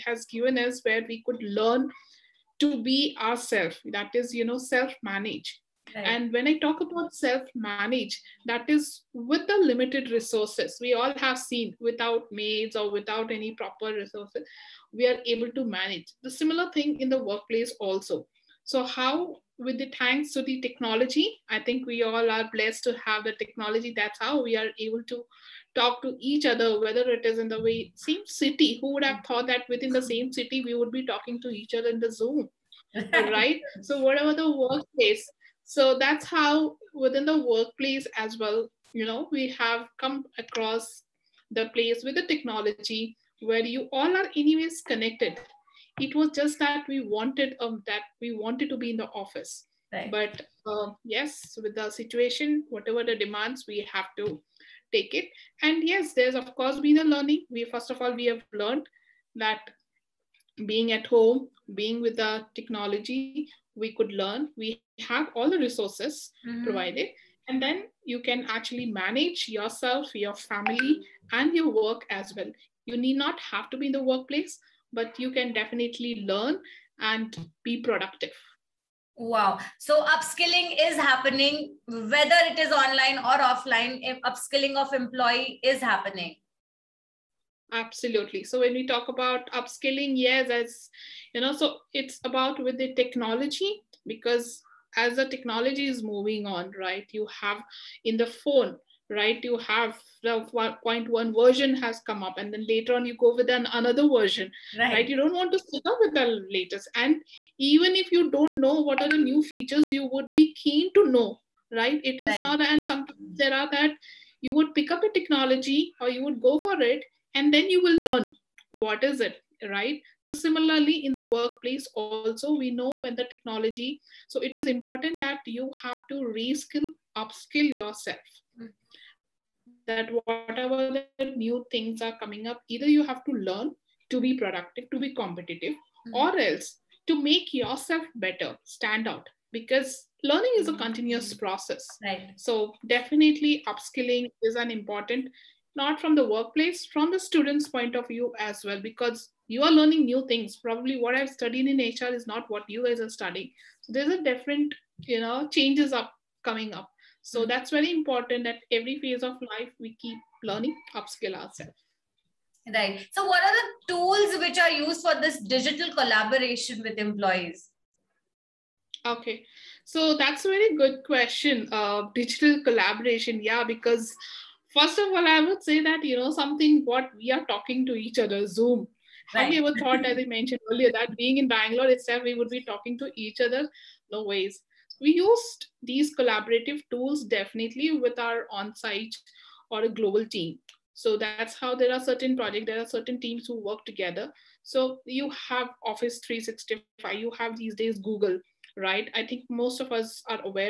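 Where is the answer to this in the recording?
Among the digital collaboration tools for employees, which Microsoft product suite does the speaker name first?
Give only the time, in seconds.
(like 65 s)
195 s.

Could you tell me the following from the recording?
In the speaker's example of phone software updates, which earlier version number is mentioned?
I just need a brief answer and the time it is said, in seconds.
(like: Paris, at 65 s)
1.1, at 100 s.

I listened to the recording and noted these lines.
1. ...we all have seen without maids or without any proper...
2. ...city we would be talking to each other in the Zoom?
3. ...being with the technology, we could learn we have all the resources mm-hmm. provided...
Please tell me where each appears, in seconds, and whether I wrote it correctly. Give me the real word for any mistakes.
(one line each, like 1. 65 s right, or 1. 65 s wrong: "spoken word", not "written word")
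1. 10 s right
2. 30 s right
3. 61 s right.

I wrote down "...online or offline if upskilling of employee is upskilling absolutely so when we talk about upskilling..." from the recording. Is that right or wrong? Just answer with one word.
wrong.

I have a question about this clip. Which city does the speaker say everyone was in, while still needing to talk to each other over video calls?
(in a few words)
Bangalore.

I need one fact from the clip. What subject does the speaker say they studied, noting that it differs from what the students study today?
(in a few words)
HR.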